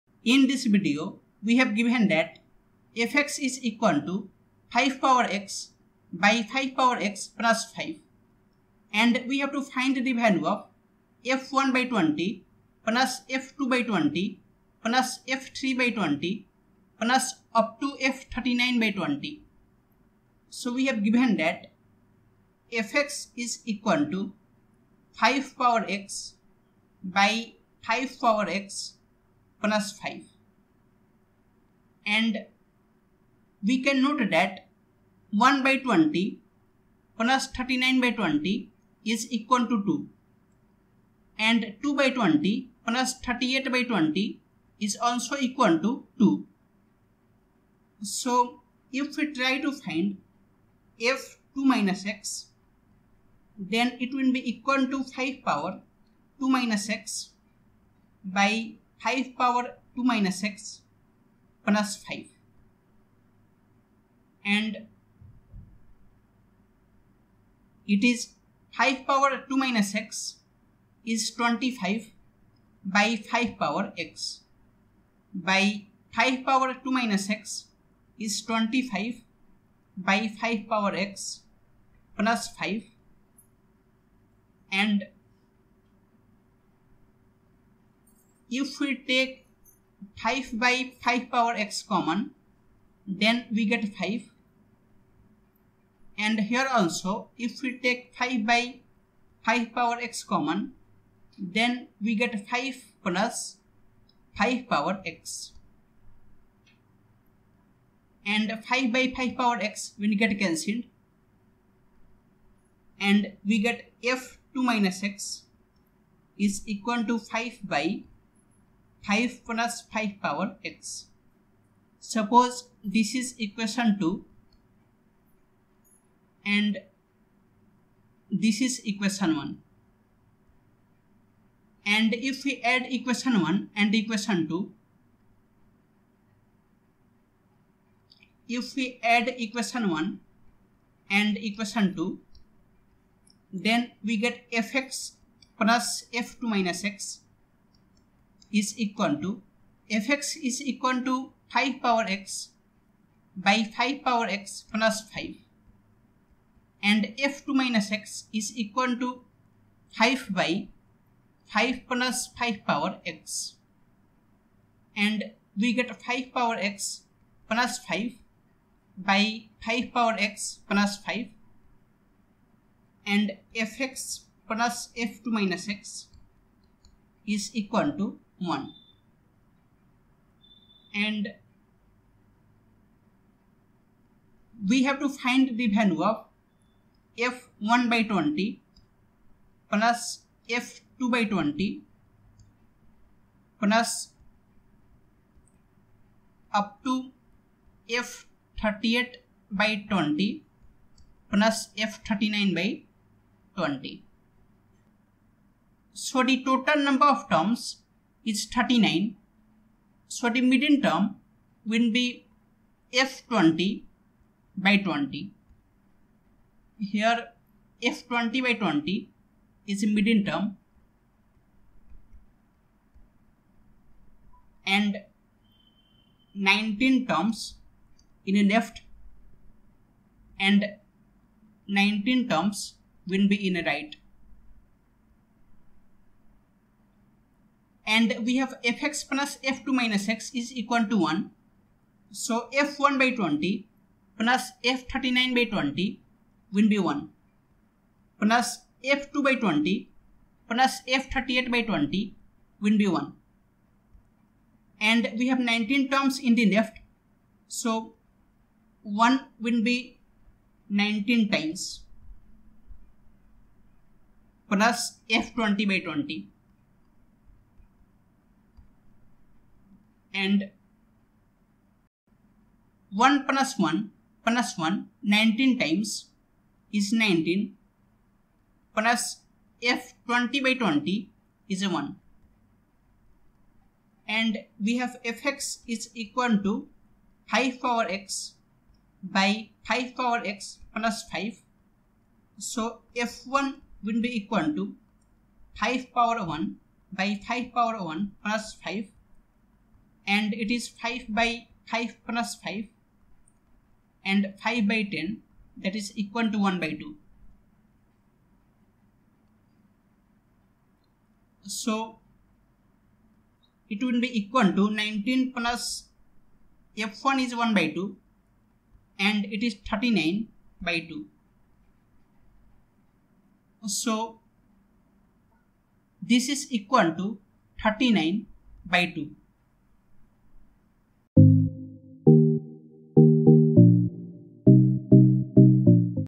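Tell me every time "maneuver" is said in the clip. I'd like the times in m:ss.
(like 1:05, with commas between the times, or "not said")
not said.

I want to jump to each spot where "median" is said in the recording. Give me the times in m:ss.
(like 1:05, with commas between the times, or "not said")
3:30, 3:39.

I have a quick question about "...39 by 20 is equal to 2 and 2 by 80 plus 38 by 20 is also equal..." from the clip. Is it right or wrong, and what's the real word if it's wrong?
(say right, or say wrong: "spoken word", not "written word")
wrong: "20", not "80".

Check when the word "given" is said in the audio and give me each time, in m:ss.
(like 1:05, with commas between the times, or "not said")
0:01, 0:21.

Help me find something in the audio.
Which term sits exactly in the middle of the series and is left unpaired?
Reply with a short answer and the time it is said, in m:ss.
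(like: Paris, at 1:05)
f(20/20), at 3:37.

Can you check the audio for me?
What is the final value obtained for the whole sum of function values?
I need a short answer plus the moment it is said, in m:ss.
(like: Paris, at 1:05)
39/2, at 5:26.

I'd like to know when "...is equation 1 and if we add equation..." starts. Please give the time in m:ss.
2:08.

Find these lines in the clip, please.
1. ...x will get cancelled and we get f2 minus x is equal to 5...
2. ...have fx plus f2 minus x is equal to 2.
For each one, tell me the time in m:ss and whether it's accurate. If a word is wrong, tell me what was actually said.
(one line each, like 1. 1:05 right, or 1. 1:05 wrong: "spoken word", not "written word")
1. 1:49 right
2. 3:58 wrong: "1", not "2".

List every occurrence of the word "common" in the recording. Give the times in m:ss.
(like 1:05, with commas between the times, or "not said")
1:31, 1:40.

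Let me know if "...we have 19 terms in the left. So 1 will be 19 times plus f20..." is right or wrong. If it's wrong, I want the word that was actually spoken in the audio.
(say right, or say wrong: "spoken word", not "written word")
right.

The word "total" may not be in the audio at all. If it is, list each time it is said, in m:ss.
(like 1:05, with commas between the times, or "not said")
3:26.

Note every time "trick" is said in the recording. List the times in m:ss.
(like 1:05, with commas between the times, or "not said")
not said.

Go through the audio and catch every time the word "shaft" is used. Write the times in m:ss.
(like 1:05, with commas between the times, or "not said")
not said.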